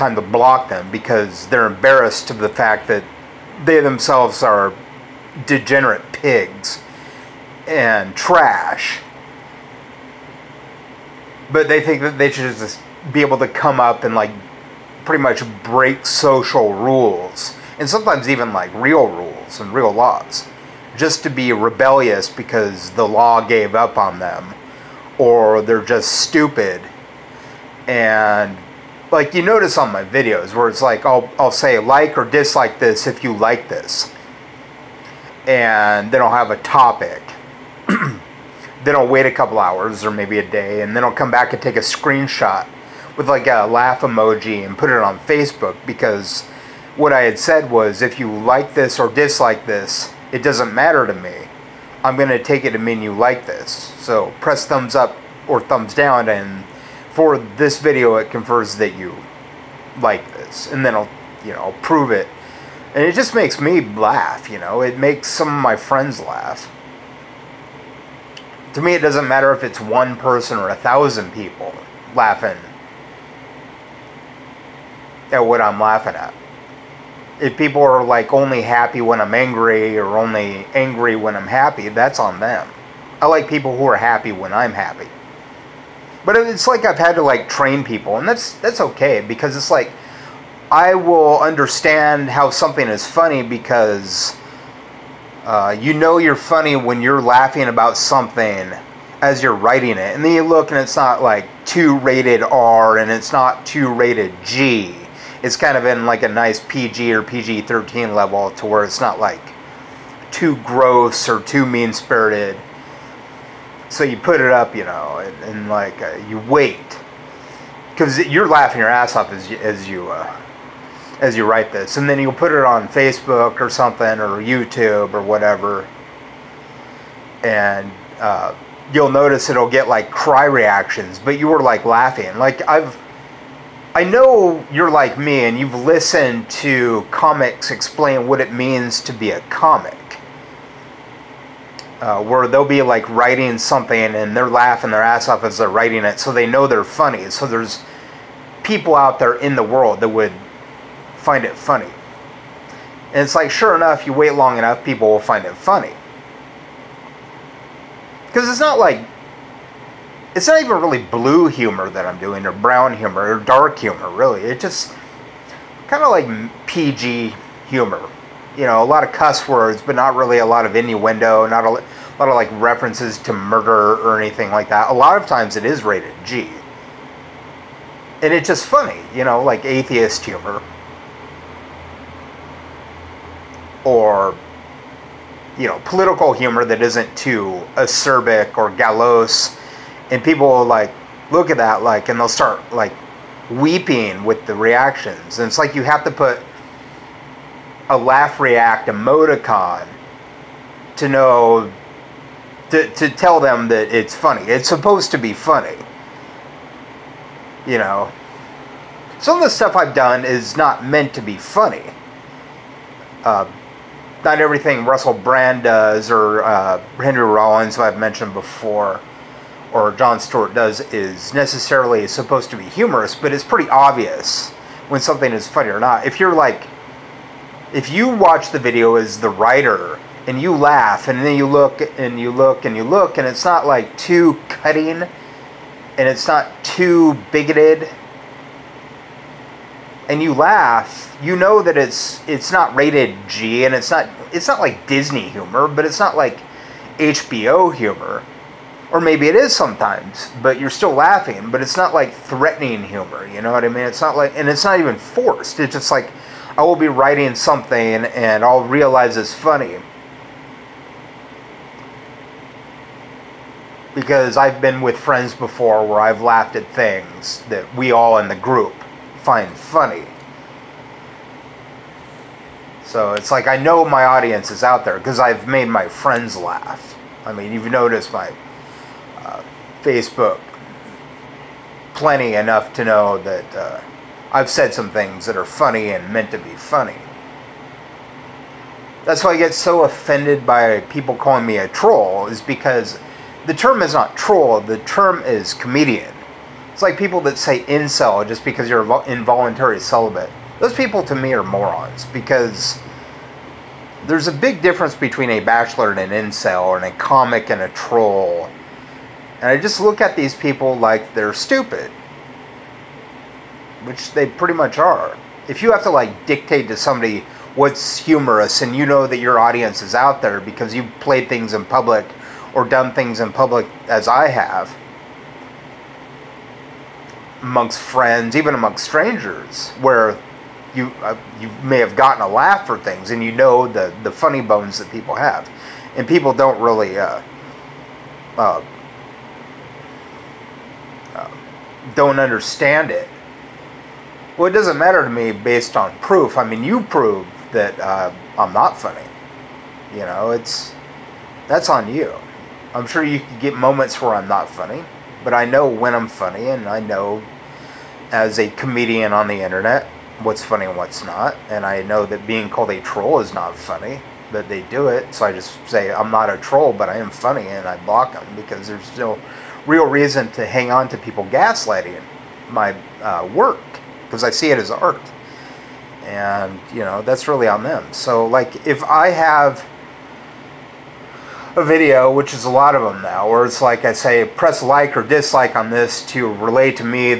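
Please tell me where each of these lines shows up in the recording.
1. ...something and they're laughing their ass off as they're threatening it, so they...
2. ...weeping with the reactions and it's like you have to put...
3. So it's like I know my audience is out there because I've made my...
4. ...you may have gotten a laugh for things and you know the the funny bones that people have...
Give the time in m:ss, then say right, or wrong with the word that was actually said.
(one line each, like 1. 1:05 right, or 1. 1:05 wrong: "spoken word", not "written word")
1. 2:23 wrong: "writing", not "threatening"
2. 3:13 right
3. 4:32 right
4. 5:31 right.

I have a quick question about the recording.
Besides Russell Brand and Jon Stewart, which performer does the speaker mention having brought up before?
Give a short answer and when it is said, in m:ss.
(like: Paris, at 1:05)
Henry Rollins, at 3:36.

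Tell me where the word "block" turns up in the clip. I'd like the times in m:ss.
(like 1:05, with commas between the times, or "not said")
0:00, 6:07.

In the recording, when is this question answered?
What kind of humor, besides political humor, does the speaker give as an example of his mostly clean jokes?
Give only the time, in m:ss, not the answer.
2:59.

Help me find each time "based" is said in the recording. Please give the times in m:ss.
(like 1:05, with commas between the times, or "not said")
5:45.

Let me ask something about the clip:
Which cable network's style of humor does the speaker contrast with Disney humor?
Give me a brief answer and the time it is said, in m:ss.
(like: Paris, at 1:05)
HBO, at 4:06.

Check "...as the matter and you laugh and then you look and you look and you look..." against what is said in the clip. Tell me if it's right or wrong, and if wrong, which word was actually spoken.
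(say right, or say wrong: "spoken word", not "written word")
wrong: "writer", not "matter".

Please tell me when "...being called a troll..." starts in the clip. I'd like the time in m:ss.
6:02.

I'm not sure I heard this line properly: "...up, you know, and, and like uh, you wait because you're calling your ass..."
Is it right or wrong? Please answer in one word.
wrong.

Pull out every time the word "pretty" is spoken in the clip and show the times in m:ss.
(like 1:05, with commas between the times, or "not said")
0:15, 3:43, 5:14.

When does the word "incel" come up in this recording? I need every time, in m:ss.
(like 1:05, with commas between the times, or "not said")
4:57, 5:06.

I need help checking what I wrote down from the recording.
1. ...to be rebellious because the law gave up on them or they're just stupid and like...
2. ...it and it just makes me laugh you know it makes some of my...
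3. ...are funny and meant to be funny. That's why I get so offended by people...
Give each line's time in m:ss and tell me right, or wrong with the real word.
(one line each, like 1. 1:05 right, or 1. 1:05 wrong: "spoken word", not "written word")
1. 0:21 right
2. 1:02 right
3. 4:45 right.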